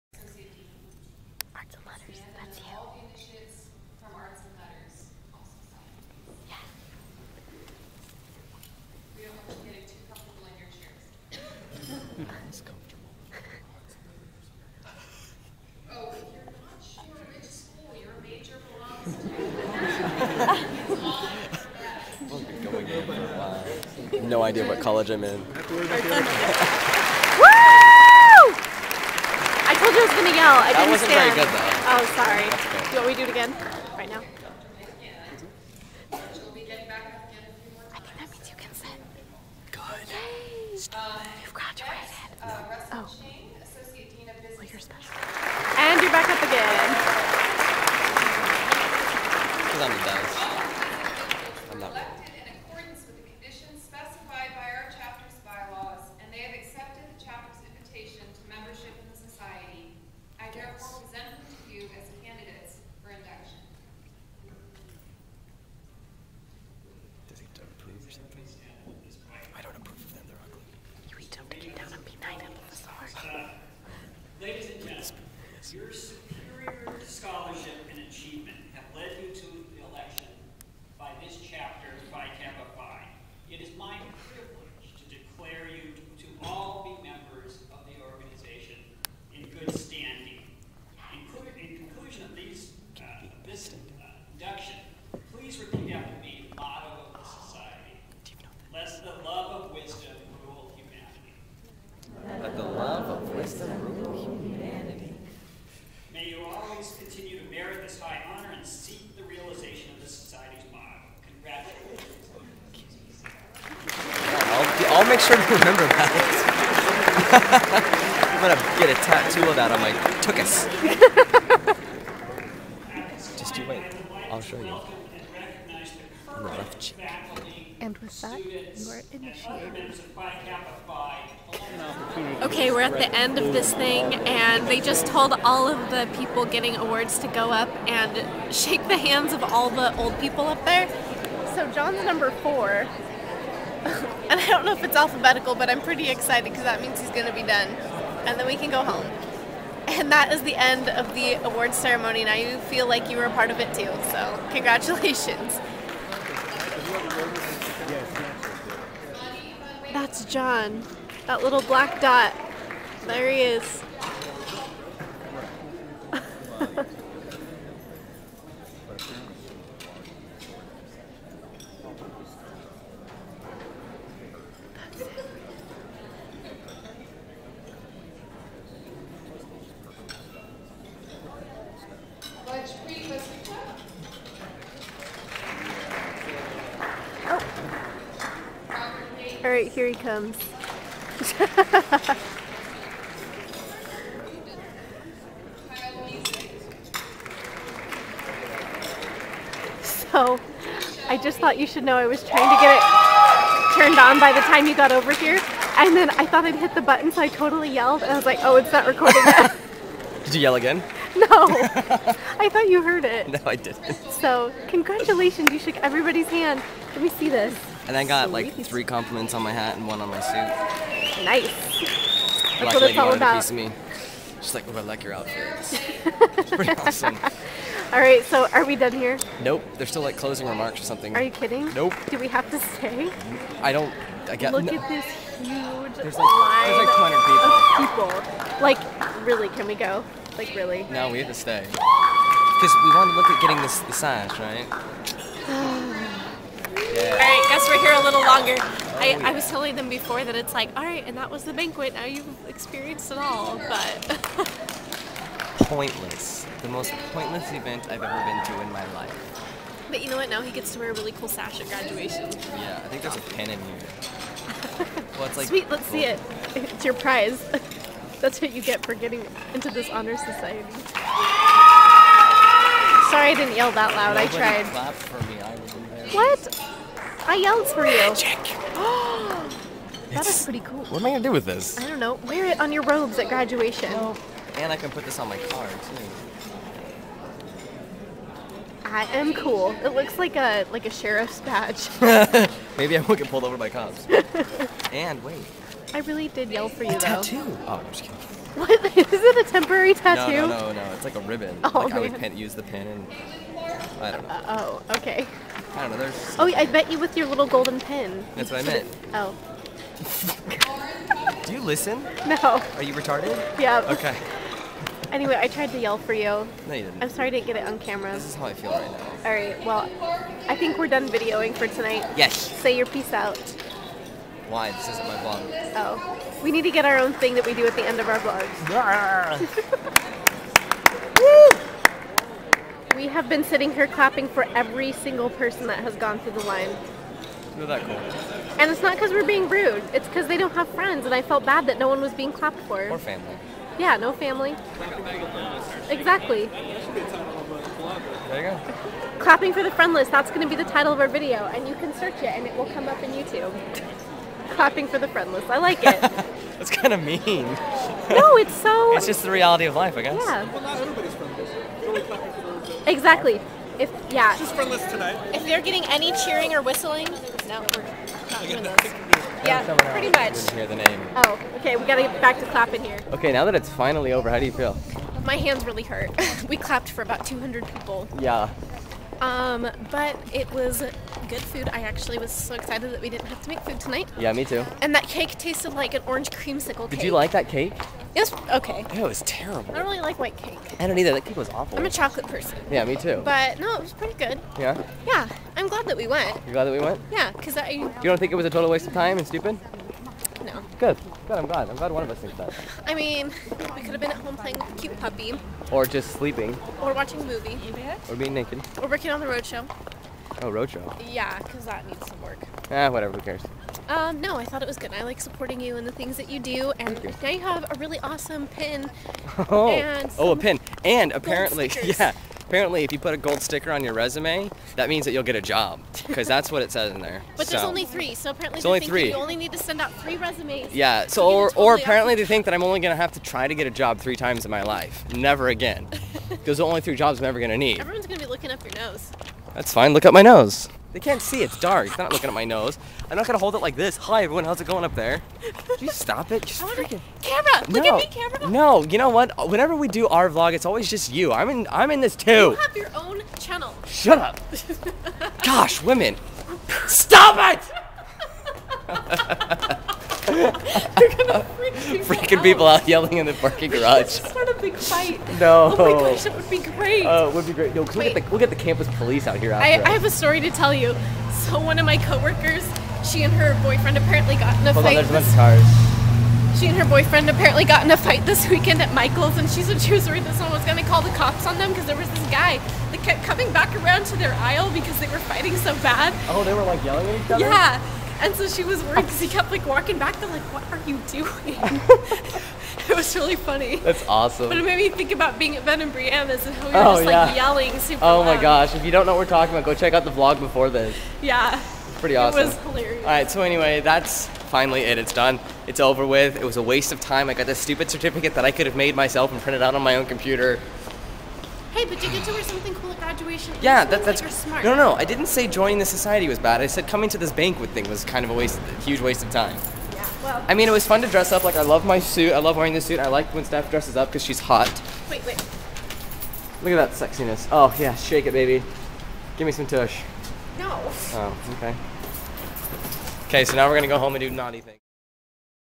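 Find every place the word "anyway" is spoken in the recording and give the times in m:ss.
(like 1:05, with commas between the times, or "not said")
5:15, 8:23.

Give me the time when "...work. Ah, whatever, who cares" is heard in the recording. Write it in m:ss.
6:52.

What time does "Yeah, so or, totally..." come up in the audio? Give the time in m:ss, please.
7:10.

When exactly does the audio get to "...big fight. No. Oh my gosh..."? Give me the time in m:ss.
7:44.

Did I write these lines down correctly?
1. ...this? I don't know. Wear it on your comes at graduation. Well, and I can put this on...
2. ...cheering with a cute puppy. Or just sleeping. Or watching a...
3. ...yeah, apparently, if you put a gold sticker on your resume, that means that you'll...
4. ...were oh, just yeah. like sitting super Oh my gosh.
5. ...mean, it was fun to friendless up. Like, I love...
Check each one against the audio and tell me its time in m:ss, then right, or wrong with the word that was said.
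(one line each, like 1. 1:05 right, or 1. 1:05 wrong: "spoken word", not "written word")
1. 4:41 wrong: "robes", not "comes"
2. 6:44 wrong: "playing", not "cheering"
3. 7:01 right
4. 8:16 wrong: "yelling", not "sitting"
5. 8:40 wrong: "dress", not "friendless".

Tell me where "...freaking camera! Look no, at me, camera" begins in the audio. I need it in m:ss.
7:26.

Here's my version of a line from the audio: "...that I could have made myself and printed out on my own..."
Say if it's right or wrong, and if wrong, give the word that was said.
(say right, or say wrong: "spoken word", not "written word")
right.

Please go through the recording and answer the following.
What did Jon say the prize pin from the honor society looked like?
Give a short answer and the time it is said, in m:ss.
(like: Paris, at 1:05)
a sheriff's badge, at 4:50.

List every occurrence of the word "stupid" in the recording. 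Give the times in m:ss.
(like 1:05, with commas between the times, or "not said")
0:40, 6:39, 8:27.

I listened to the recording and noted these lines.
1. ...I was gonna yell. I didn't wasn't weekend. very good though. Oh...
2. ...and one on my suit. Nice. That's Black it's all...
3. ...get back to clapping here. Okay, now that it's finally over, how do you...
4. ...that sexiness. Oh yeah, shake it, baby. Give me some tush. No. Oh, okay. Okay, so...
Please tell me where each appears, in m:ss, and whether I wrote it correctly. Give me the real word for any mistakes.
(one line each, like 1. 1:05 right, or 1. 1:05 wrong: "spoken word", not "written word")
1. 0:30 wrong: "stand", not "weekend"
2. 3:39 right
3. 6:12 right
4. 8:46 right.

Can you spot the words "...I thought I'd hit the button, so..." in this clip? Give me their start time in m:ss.
3:26.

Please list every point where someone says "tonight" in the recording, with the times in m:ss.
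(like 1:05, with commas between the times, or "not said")
5:21, 6:04, 6:23.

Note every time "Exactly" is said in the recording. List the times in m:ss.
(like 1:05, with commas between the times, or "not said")
5:45, 6:02.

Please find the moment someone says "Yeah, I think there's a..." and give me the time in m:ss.
4:22.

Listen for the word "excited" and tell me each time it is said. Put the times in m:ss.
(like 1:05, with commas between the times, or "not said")
2:26, 6:22.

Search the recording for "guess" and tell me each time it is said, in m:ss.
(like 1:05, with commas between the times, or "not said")
3:54, 6:00.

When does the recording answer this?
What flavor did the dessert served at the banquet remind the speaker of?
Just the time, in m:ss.
6:26.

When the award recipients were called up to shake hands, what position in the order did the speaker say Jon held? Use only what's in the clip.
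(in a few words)
4.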